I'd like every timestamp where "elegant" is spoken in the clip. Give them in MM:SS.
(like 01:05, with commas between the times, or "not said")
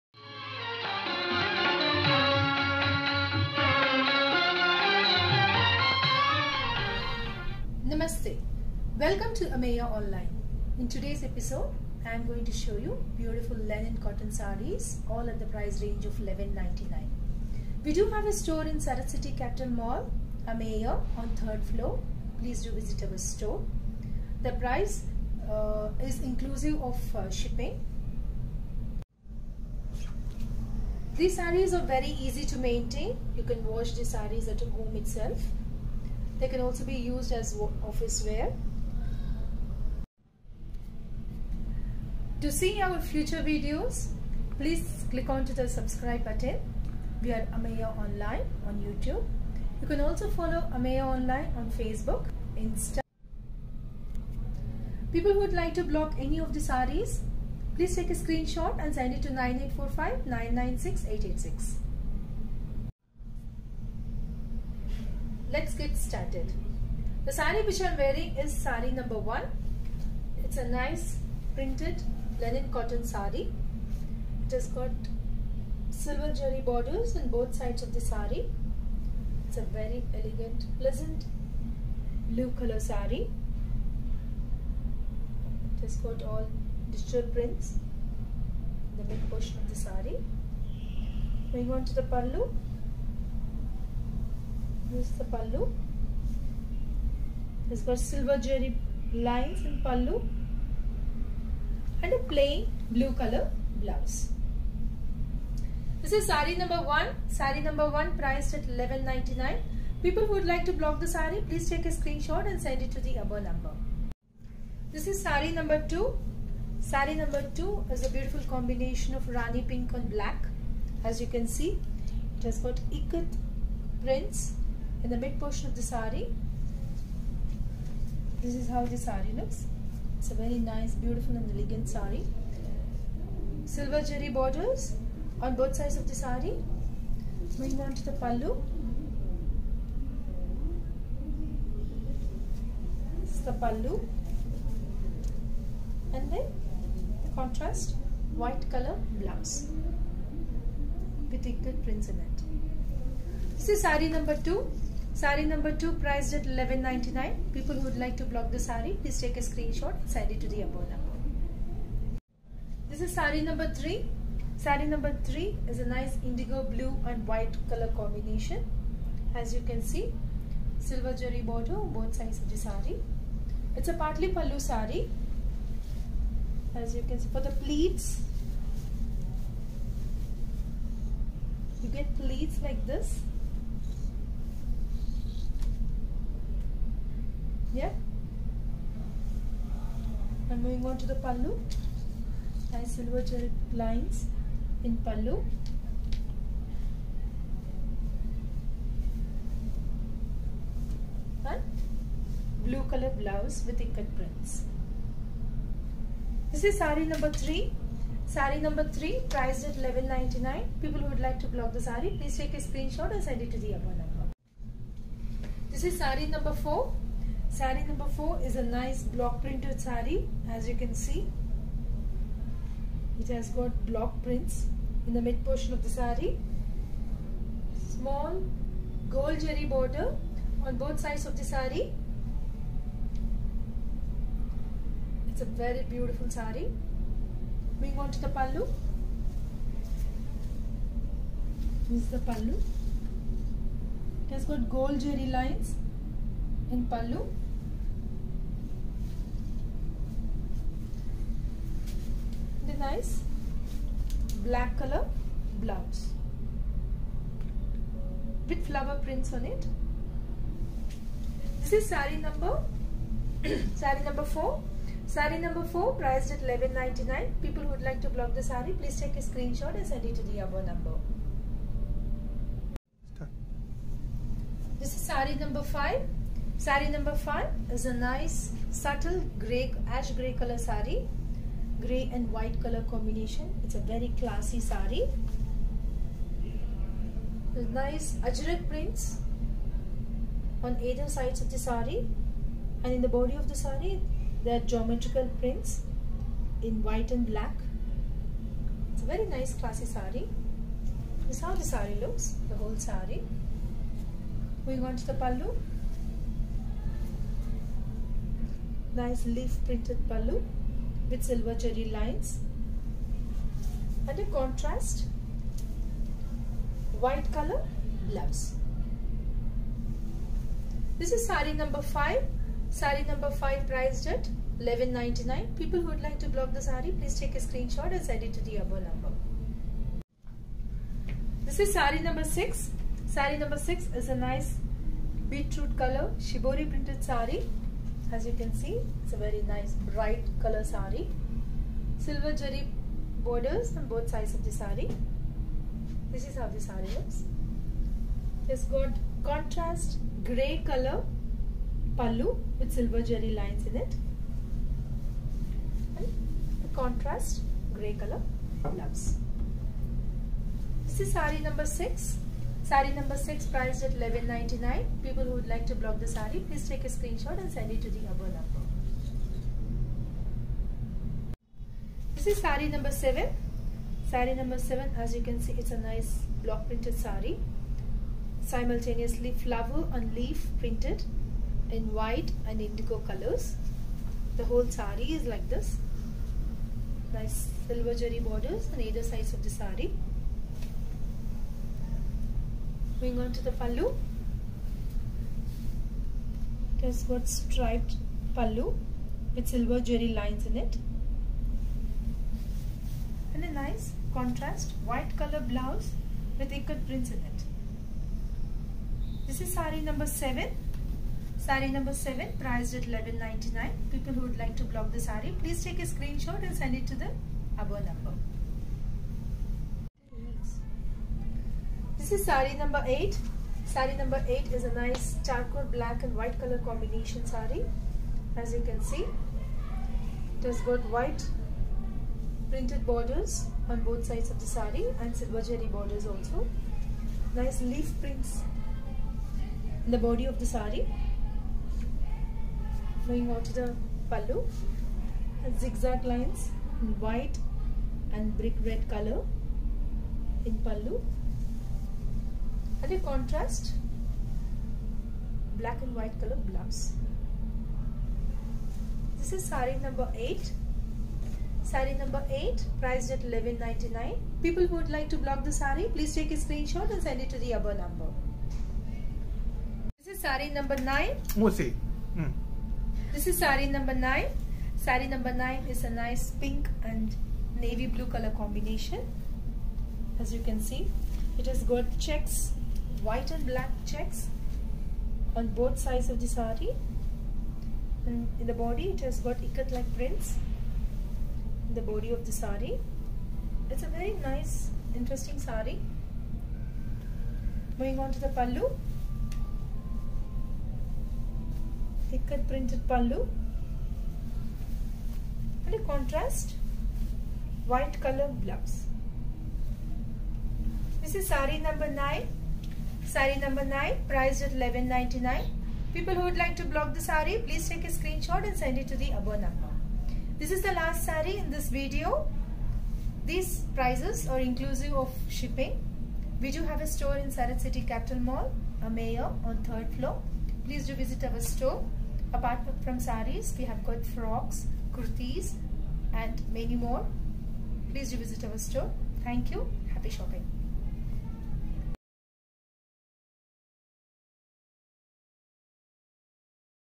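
01:20, 02:11.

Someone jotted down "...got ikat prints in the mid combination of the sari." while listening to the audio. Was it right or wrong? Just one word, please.
wrong.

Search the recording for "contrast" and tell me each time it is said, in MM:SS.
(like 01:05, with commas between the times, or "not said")
02:27, 05:14, 05:49, 05:56, 06:44, 07:33, 08:25.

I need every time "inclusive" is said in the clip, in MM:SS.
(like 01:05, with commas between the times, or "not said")
00:26, 08:44.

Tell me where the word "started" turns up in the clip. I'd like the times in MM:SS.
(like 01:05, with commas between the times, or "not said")
01:05.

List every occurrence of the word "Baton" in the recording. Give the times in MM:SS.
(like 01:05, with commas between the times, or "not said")
not said.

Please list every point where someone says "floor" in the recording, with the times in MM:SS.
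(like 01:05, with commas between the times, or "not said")
00:21, 08:49.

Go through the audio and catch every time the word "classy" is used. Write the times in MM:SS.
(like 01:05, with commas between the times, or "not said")
04:44, 04:59.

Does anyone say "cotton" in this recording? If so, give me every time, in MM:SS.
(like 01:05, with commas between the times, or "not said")
00:13, 01:12.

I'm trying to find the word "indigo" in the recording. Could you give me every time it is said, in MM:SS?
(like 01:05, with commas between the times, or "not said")
02:46, 06:22.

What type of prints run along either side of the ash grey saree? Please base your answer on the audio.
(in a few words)
ajrak prints.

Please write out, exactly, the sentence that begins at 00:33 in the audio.
You can wash the sarees at home itself.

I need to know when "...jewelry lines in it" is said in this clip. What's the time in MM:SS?
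06:39.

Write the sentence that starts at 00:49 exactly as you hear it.
You can also follow Ameya Online on Facebook, Insta.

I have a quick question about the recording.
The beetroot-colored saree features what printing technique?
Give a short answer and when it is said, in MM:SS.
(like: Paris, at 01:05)
shibori, at 05:36.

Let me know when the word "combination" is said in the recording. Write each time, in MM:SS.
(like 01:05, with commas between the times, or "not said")
01:58, 02:47, 04:42, 07:06, 07:58.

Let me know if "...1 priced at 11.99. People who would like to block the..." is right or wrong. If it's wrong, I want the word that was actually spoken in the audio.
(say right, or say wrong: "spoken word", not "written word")
wrong: "7", not "1".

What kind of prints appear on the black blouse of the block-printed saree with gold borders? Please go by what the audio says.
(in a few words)
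flower prints.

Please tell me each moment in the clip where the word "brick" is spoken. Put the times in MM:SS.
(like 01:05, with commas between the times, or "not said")
07:28.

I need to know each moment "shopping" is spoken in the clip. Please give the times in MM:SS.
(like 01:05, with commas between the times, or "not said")
09:00.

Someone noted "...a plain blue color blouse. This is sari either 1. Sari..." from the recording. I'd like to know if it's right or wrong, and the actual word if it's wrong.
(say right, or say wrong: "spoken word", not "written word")
wrong: "number", not "either".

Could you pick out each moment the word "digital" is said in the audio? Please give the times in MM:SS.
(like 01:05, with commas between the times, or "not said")
01:26.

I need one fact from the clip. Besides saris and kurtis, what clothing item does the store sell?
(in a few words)
frocks.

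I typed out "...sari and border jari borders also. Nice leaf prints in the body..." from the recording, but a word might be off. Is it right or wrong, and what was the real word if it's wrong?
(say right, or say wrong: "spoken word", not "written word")
wrong: "silver", not "border".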